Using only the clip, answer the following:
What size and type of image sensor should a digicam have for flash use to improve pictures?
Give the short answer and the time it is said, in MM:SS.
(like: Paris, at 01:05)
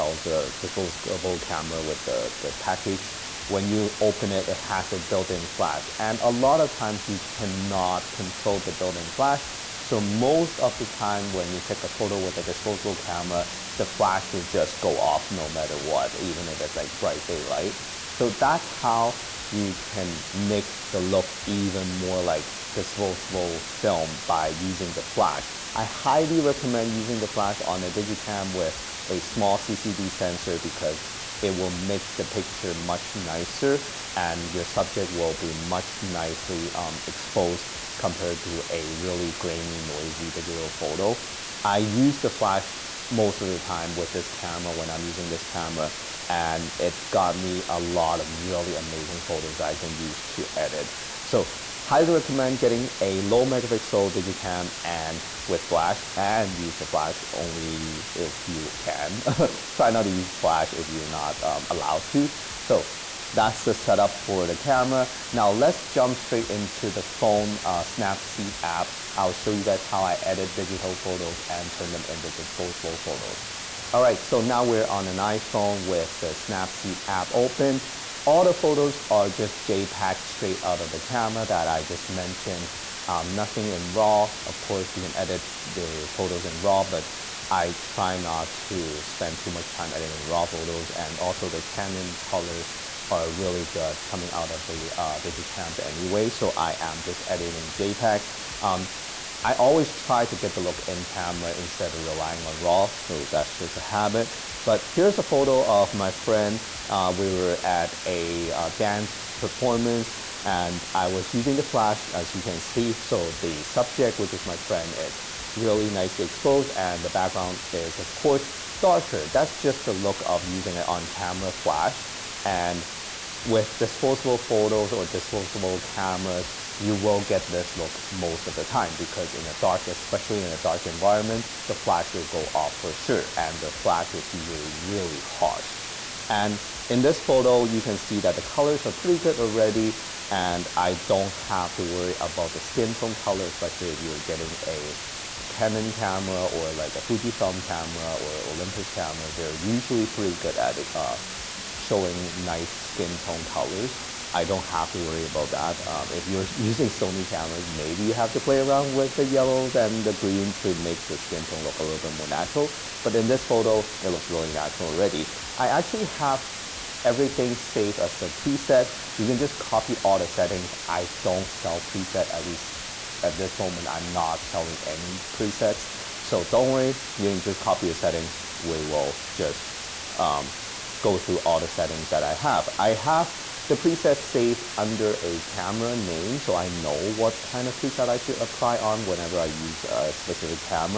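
small CCD sensor, at 00:29.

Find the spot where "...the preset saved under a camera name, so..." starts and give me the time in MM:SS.
03:03.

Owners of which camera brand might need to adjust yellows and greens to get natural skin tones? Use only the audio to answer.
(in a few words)
Sony.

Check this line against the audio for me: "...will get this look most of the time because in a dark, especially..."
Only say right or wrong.
right.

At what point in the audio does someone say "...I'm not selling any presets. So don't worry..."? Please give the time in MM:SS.
02:53.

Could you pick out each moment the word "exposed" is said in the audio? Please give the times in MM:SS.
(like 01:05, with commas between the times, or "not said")
00:37, 01:56.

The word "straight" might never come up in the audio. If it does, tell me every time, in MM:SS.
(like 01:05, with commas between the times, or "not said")
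01:06, 01:20.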